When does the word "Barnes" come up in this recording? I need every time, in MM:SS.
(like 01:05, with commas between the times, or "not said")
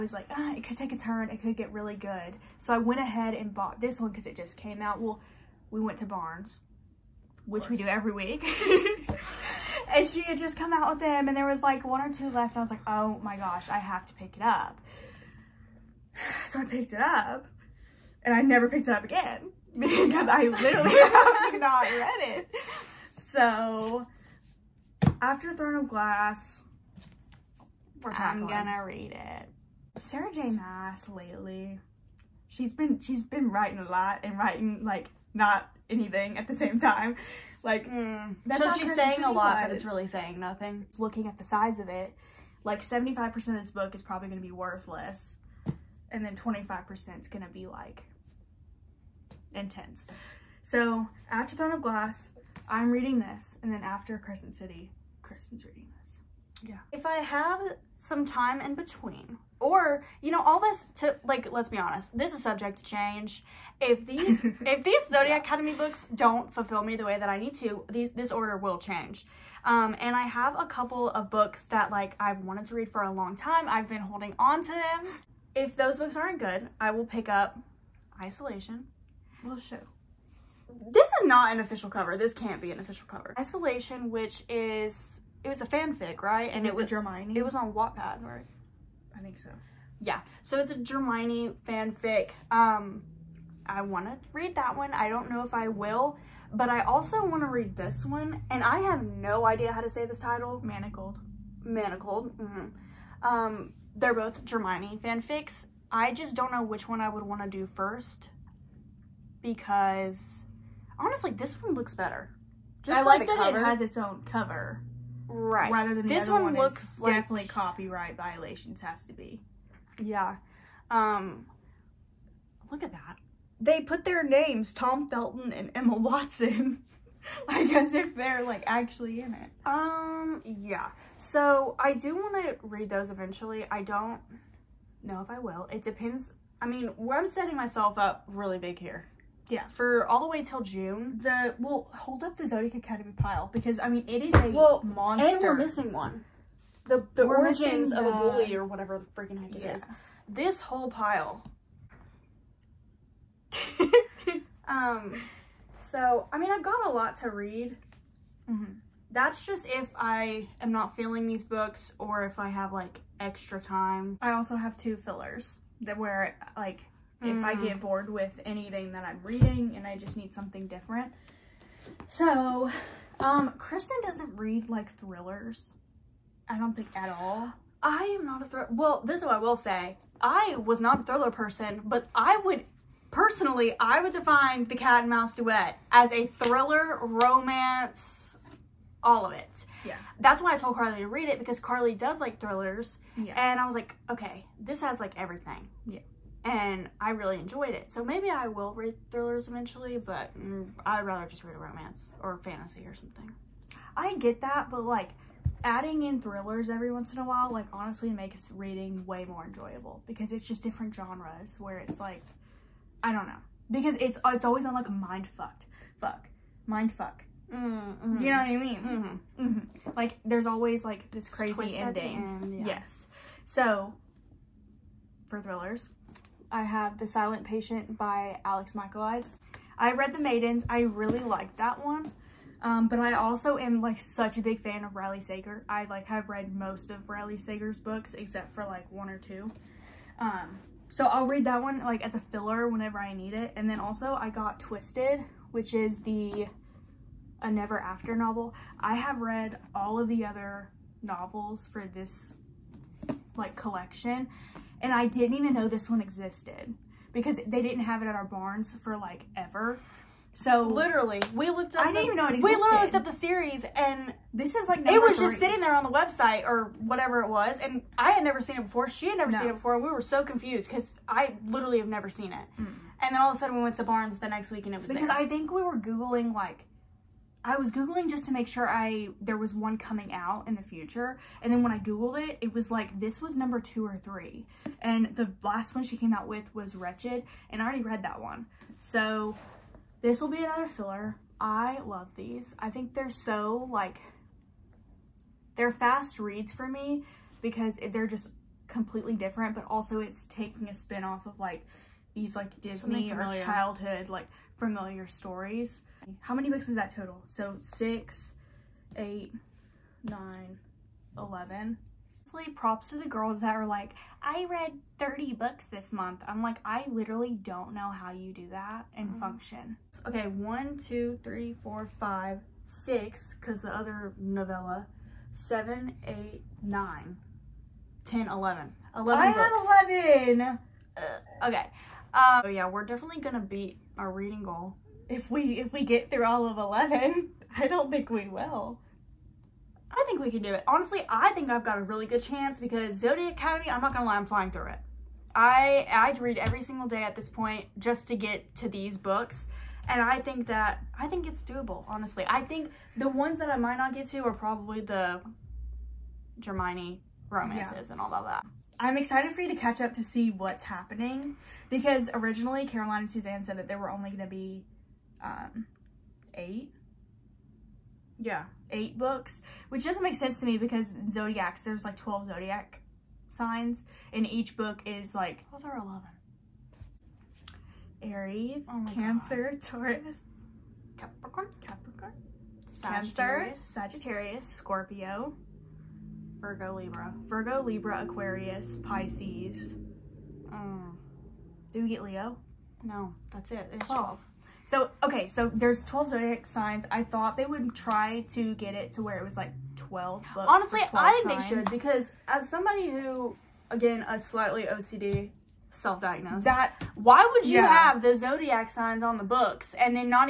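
00:06, 04:18, 04:33.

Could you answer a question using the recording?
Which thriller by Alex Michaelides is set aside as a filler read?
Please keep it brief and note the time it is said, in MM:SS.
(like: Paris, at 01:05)
The Silent Patient, at 03:46.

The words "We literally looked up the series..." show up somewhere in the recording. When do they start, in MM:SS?
04:22.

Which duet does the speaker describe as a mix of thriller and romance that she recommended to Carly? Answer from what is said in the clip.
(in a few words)
cat and mouse duet.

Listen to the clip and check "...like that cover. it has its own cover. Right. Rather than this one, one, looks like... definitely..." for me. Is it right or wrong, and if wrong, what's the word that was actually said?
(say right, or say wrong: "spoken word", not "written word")
right.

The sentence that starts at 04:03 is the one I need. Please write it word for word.
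And then also I got Twisted, which is the a Never After novel.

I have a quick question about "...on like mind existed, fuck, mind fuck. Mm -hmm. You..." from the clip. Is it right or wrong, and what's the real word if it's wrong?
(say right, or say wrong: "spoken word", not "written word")
wrong: "fucked", not "existed".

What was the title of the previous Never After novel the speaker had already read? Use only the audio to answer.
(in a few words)
Wretched.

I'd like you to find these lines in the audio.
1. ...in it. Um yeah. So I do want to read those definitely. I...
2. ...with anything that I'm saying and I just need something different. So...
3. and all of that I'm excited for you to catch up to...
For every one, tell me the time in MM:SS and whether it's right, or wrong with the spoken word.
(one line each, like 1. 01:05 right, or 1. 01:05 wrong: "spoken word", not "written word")
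1. 02:09 wrong: "eventually", not "definitely"
2. 02:48 wrong: "reading", not "saying"
3. 05:57 right.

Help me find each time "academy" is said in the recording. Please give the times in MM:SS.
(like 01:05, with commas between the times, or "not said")
01:05, 02:22, 05:43.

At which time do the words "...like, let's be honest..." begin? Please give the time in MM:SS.
01:01.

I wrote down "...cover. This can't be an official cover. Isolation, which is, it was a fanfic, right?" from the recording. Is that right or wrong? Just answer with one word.
right.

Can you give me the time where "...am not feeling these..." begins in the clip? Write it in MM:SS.
02:40.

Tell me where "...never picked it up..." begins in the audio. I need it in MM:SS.
00:18.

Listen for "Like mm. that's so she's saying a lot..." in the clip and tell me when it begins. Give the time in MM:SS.
00:37.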